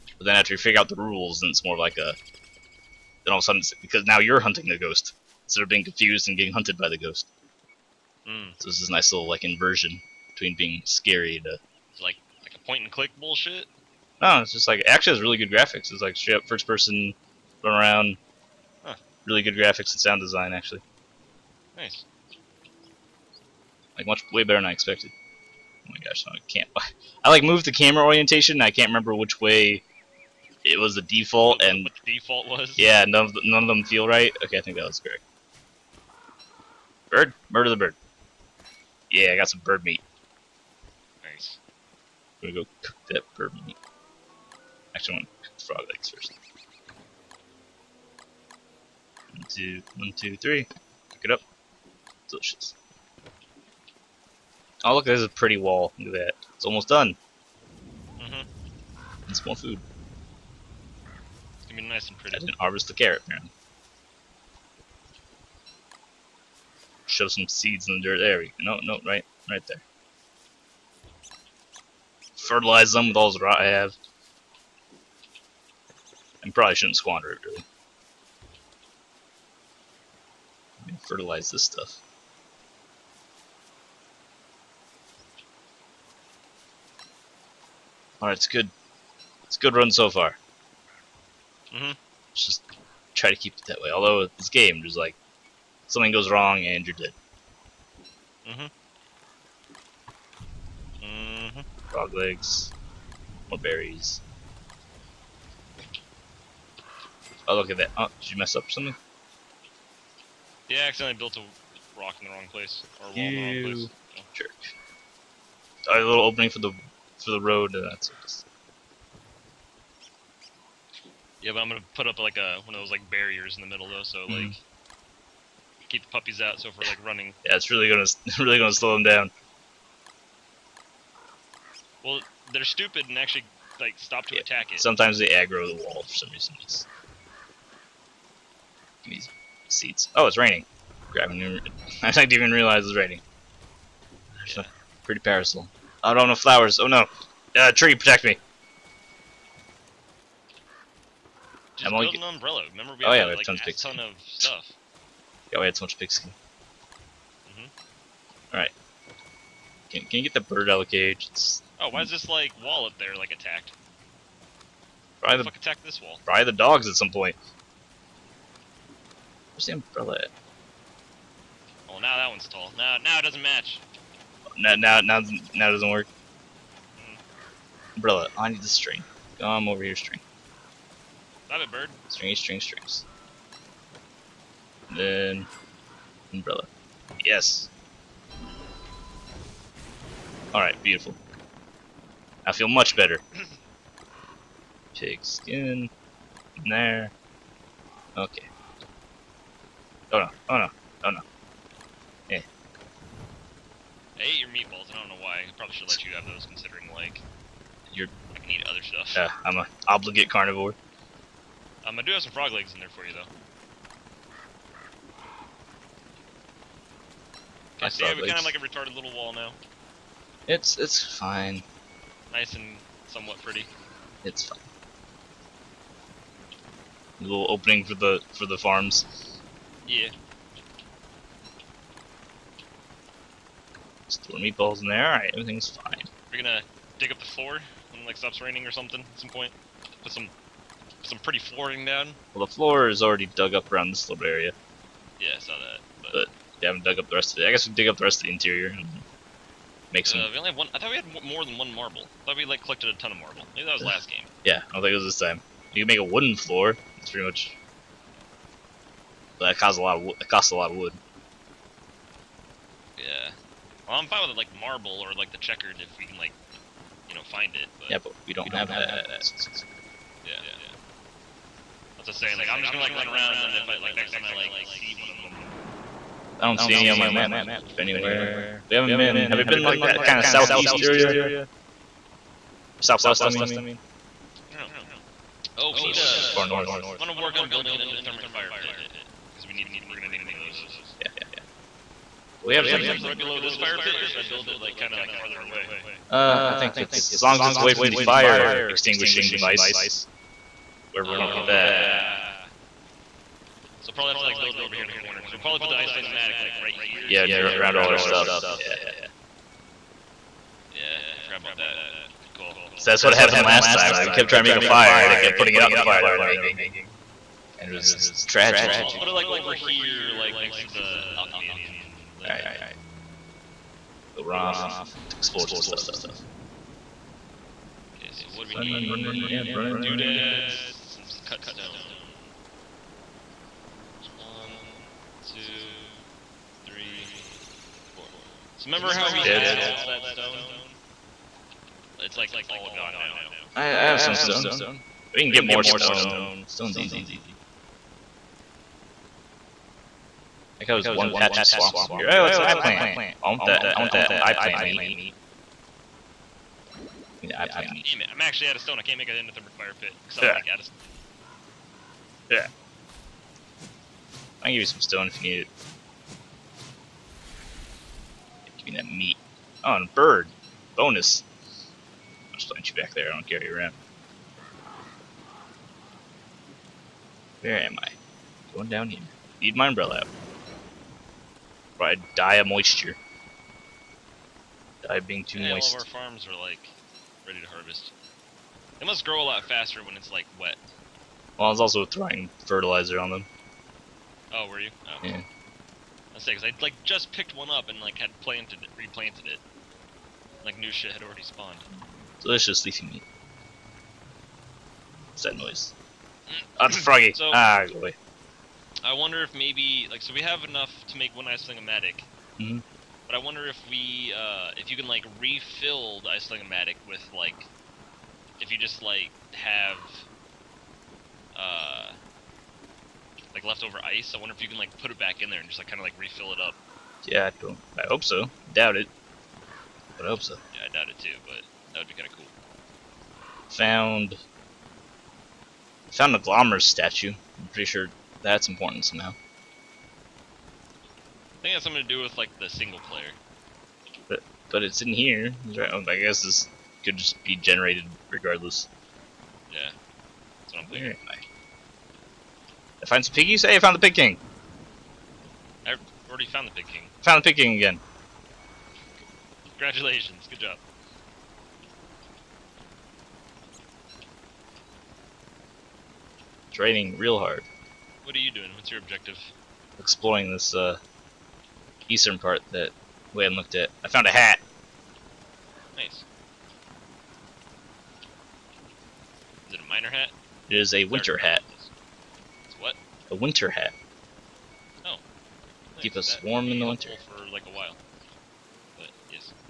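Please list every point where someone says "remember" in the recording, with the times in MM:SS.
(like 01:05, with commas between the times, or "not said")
00:28, 02:32, 05:38.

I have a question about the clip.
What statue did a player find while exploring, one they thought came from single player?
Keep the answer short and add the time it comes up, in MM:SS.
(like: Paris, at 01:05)
Glommer's statue, at 07:16.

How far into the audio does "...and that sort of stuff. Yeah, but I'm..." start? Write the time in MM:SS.
01:57.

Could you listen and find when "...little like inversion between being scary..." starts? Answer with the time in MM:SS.
00:09.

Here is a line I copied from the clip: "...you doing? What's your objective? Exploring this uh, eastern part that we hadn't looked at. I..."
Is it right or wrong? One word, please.
right.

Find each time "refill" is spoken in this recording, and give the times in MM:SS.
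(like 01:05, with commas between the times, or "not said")
06:55, 07:05.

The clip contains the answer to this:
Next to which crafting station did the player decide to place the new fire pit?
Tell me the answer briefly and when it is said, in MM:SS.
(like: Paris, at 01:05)
Alchemy engine, at 05:21.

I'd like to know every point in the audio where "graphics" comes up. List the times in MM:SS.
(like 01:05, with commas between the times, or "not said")
00:15, 00:19.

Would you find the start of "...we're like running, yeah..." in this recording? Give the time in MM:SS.
02:06.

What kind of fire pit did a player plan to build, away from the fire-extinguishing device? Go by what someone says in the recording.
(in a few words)
Endothermic fire pit.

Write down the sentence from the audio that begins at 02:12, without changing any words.
Well, they're stupid and actually like stop to yeah.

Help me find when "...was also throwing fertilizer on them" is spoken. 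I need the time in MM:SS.
06:31.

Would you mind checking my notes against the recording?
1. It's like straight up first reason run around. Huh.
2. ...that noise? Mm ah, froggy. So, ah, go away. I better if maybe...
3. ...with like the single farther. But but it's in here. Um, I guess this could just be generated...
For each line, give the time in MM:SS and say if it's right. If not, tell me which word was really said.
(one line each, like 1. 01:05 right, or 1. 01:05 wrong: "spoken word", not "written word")
1. 00:15 wrong: "person", not "reason"
2. 06:45 wrong: "wonder", not "better"
3. 07:22 wrong: "player", not "farther".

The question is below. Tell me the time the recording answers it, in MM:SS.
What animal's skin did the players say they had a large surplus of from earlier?
02:35.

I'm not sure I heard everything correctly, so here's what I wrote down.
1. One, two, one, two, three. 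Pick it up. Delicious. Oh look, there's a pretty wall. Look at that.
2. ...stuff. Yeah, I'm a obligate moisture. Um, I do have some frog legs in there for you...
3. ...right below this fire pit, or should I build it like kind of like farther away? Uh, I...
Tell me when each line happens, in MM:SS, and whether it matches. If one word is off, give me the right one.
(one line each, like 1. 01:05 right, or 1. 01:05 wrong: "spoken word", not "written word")
1. 00:49 right
2. 03:28 wrong: "carnivore", not "moisture"
3. 04:53 right.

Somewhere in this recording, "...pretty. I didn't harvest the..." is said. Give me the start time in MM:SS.
01:02.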